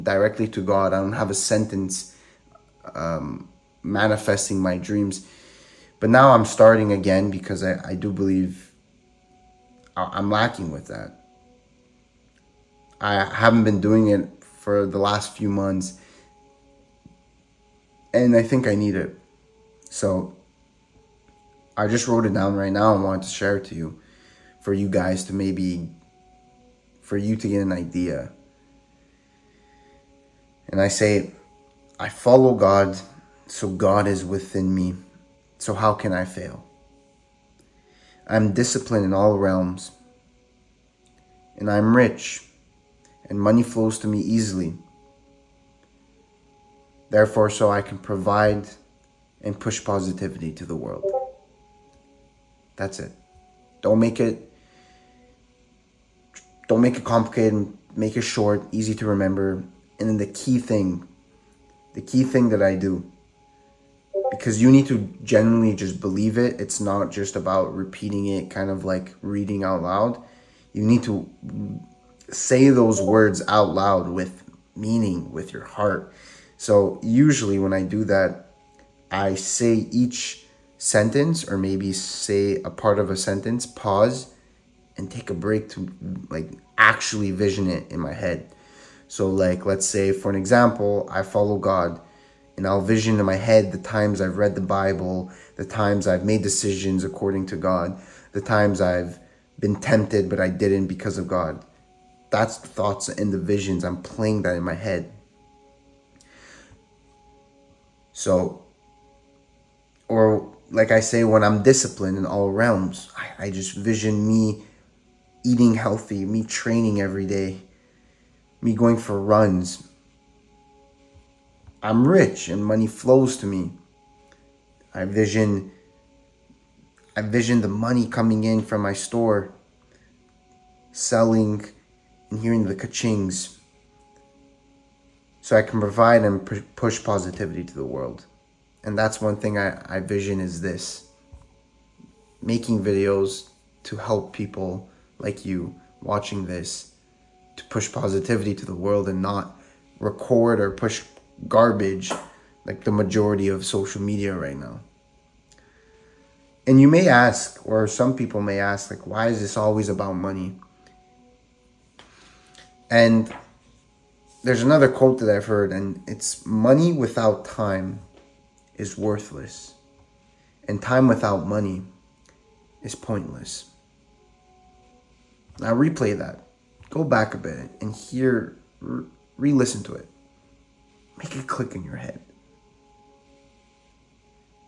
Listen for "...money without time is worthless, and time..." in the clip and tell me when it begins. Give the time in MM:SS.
02:46.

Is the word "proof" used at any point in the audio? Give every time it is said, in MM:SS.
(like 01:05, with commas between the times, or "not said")
not said.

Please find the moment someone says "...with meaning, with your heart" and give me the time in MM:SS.
01:14.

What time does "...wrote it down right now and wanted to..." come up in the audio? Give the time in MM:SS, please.
00:22.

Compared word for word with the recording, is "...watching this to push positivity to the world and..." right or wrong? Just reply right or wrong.
right.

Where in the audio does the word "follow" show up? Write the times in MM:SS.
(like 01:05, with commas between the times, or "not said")
00:32, 01:31.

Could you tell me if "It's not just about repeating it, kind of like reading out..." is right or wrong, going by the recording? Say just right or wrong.
right.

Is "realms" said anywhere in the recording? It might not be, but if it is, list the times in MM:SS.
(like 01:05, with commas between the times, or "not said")
00:39, 01:52.